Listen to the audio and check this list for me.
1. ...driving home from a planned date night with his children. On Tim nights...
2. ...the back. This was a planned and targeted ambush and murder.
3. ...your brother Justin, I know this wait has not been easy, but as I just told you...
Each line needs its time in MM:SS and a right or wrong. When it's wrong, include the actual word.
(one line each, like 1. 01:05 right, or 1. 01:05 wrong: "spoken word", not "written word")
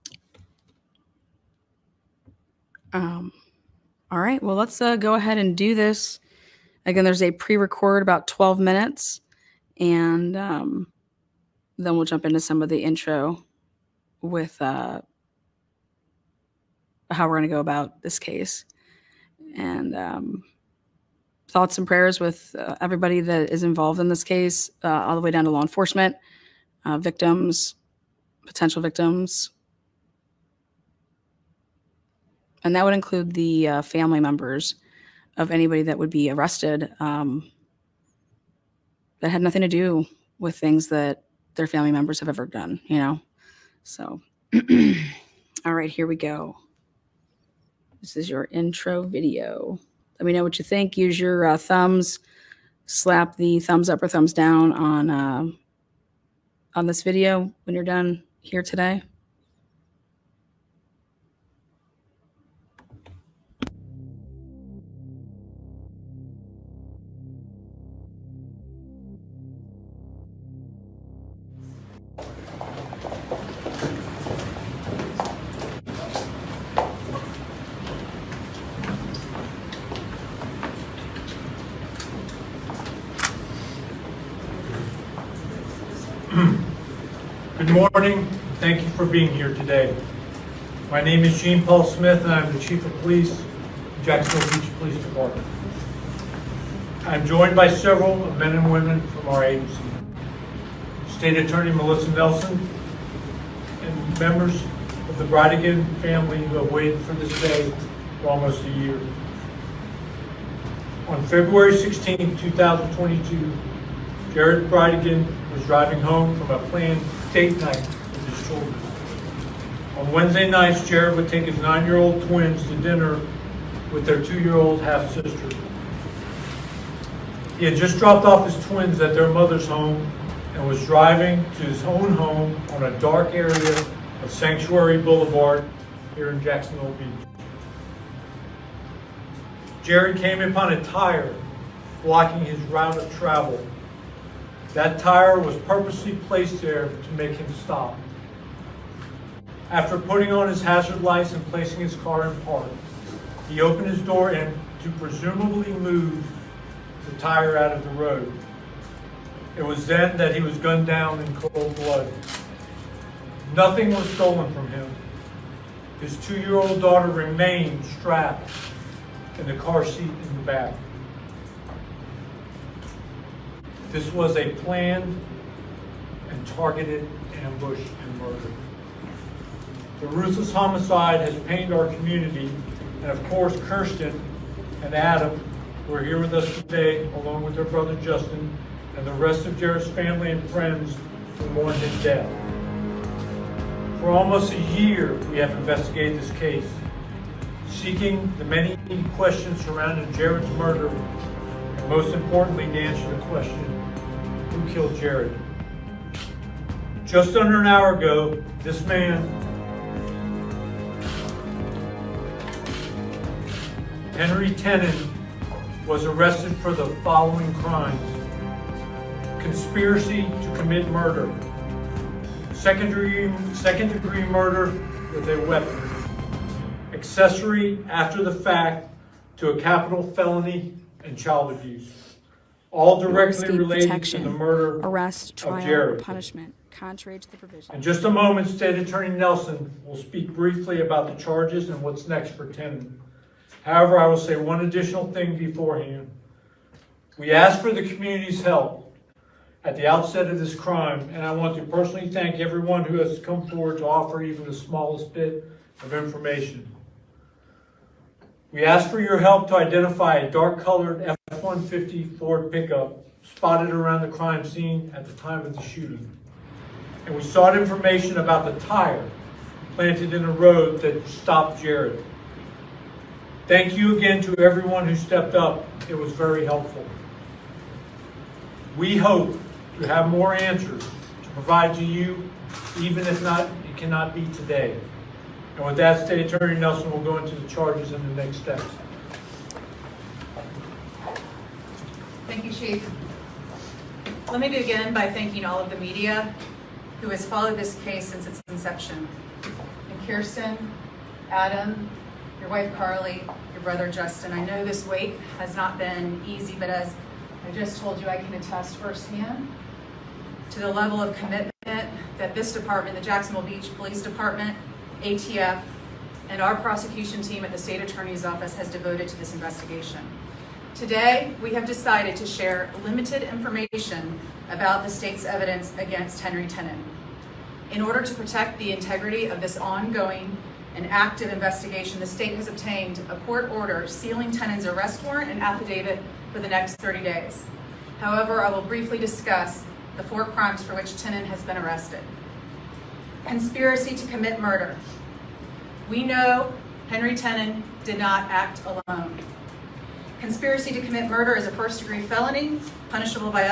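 1. 01:55 wrong: "Wednesday", not "Tim"
2. 02:50 right
3. 05:03 right.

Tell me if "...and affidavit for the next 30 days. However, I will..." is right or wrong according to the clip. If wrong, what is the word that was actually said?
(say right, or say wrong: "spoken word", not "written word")
right.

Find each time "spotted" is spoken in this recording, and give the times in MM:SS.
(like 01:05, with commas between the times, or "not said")
04:23.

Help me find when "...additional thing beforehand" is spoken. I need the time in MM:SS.
04:04.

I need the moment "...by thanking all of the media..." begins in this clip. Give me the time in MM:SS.
04:54.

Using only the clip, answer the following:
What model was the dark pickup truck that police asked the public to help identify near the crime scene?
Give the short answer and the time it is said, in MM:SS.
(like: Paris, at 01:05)
Ford F-150, at 04:21.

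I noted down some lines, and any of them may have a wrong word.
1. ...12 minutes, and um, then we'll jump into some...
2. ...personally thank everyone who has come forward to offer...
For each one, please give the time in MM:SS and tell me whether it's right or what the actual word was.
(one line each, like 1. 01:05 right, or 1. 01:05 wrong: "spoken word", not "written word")
1. 00:08 right
2. 04:11 right.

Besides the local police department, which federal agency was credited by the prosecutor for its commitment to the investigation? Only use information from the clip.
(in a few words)
ATF.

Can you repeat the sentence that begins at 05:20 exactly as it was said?
Today, we have decided to share limited information about the state's evidence against Henry Tenon.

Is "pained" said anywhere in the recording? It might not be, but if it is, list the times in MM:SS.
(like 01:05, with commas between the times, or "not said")
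03:01.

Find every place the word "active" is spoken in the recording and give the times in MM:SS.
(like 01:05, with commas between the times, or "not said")
05:30.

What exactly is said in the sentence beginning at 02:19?
Jared came upon a tire blocking his route of travel that tire was purposely placed there to make him stop.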